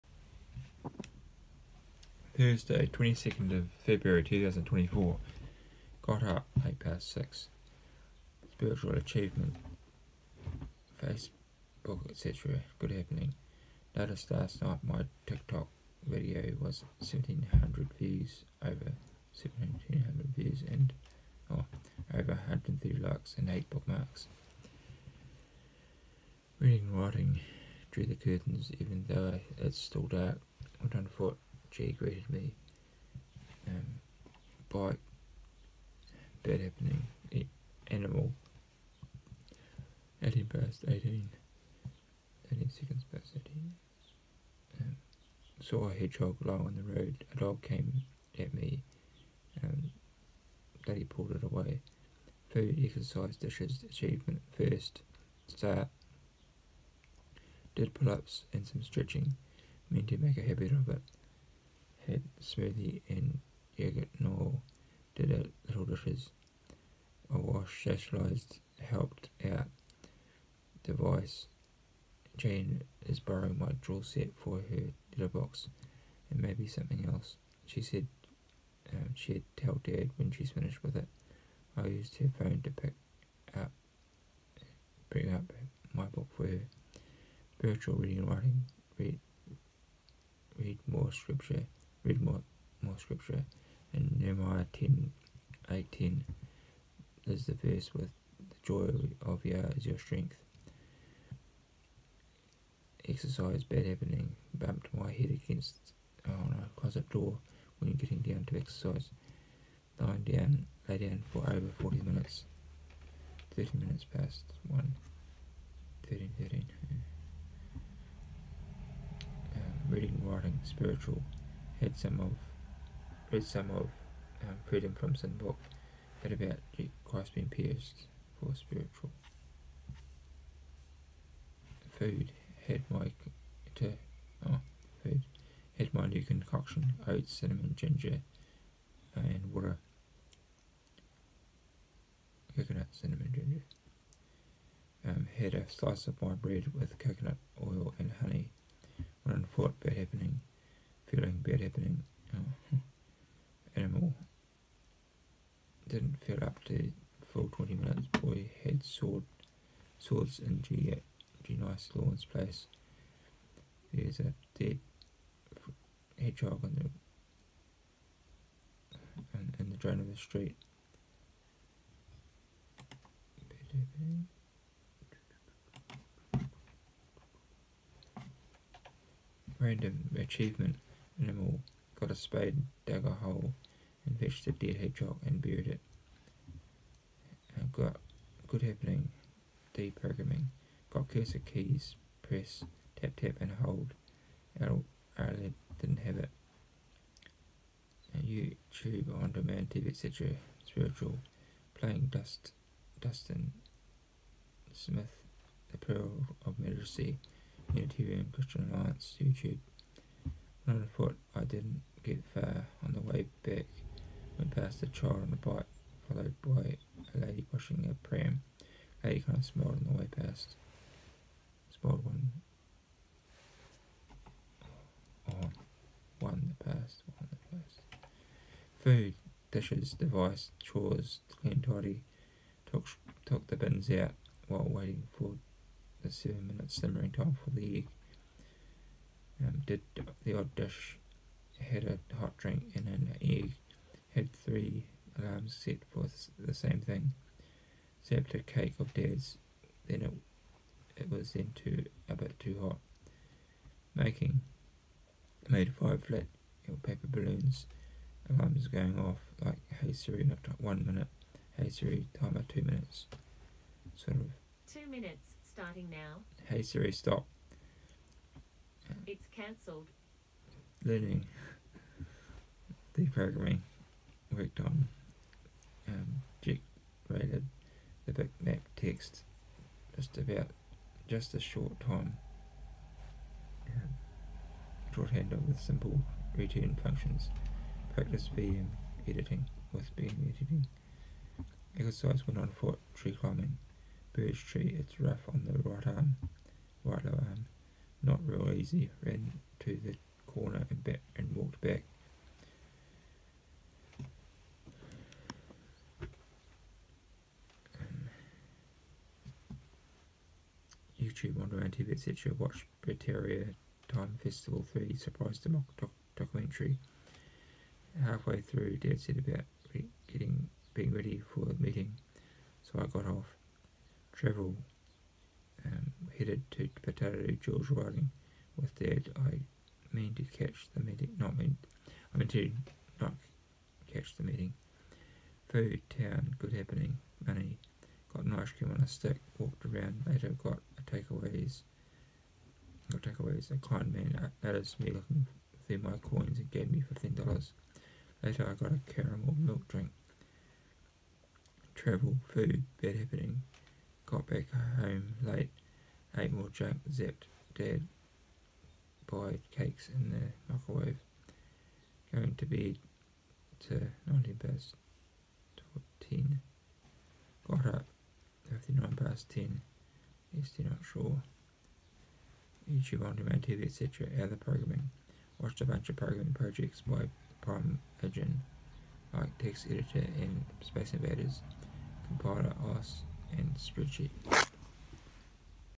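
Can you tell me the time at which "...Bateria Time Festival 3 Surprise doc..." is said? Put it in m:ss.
5:12.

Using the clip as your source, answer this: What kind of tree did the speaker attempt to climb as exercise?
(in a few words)
Birch.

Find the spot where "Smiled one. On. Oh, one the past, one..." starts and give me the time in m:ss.
3:41.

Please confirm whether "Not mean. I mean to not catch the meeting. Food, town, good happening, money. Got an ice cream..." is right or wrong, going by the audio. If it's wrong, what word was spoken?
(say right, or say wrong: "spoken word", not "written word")
right.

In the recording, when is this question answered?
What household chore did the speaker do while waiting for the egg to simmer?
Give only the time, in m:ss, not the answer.
3:53.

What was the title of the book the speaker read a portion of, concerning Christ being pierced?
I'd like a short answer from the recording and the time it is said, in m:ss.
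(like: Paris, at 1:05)
Freedom from Sin, at 2:04.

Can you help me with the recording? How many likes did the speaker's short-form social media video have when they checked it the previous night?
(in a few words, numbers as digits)
over 130.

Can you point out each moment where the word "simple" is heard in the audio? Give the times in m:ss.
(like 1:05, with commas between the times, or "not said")
4:45.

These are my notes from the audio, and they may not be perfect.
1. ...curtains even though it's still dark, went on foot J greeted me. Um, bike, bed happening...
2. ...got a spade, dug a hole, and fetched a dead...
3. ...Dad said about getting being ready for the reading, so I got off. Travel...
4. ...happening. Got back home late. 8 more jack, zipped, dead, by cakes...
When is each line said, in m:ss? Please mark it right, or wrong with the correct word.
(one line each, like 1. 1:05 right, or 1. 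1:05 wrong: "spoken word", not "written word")
1. 0:28 right
2. 3:01 right
3. 5:18 wrong: "meeting", not "reading"
4. 5:52 right.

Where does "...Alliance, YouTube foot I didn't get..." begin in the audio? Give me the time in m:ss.
3:28.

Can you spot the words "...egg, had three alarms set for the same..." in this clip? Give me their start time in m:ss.
4:03.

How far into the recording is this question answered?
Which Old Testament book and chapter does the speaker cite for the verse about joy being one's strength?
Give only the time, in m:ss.
1:34.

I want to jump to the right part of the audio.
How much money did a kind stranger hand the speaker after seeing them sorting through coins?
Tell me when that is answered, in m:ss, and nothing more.
5:46.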